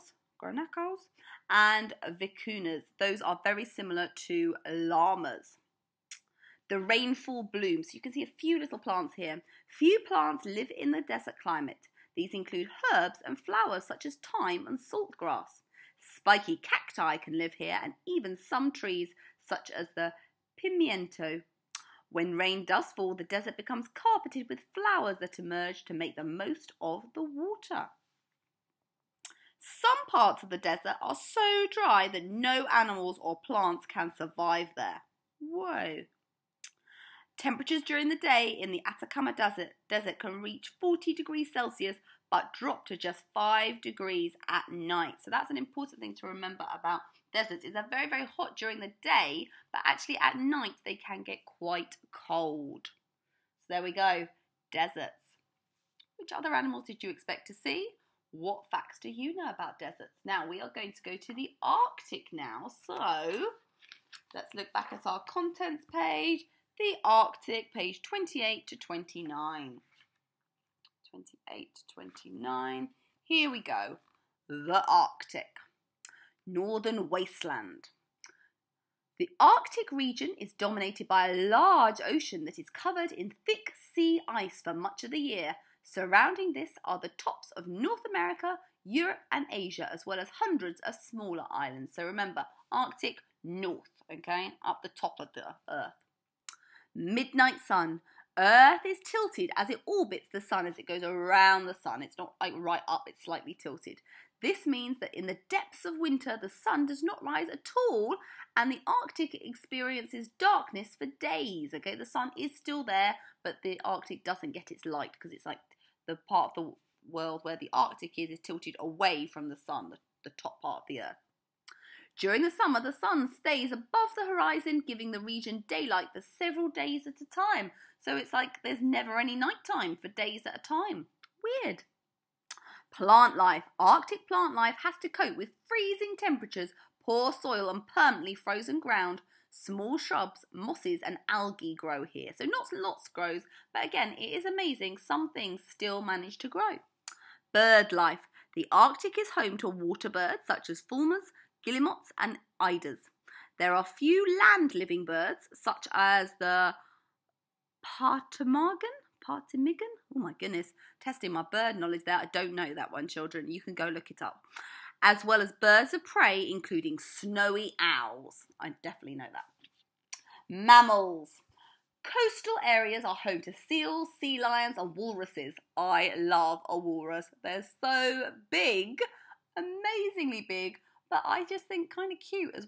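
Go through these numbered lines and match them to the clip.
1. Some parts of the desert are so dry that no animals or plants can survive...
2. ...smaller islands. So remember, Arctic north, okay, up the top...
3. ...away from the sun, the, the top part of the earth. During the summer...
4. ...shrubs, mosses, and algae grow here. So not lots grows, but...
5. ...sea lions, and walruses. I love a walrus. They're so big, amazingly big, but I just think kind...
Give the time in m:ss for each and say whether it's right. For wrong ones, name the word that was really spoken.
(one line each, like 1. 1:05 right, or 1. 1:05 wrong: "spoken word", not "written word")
1. 0:29 right
2. 1:30 right
3. 1:58 right
4. 2:19 right
5. 2:54 right.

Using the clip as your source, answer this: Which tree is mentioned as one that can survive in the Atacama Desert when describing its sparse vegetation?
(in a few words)
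pimiento.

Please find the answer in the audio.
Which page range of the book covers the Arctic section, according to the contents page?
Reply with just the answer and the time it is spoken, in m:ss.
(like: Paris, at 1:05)
28 to 29, at 1:07.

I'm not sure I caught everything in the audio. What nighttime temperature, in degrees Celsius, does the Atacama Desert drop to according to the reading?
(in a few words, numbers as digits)
5.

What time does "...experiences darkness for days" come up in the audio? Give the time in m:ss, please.
1:49.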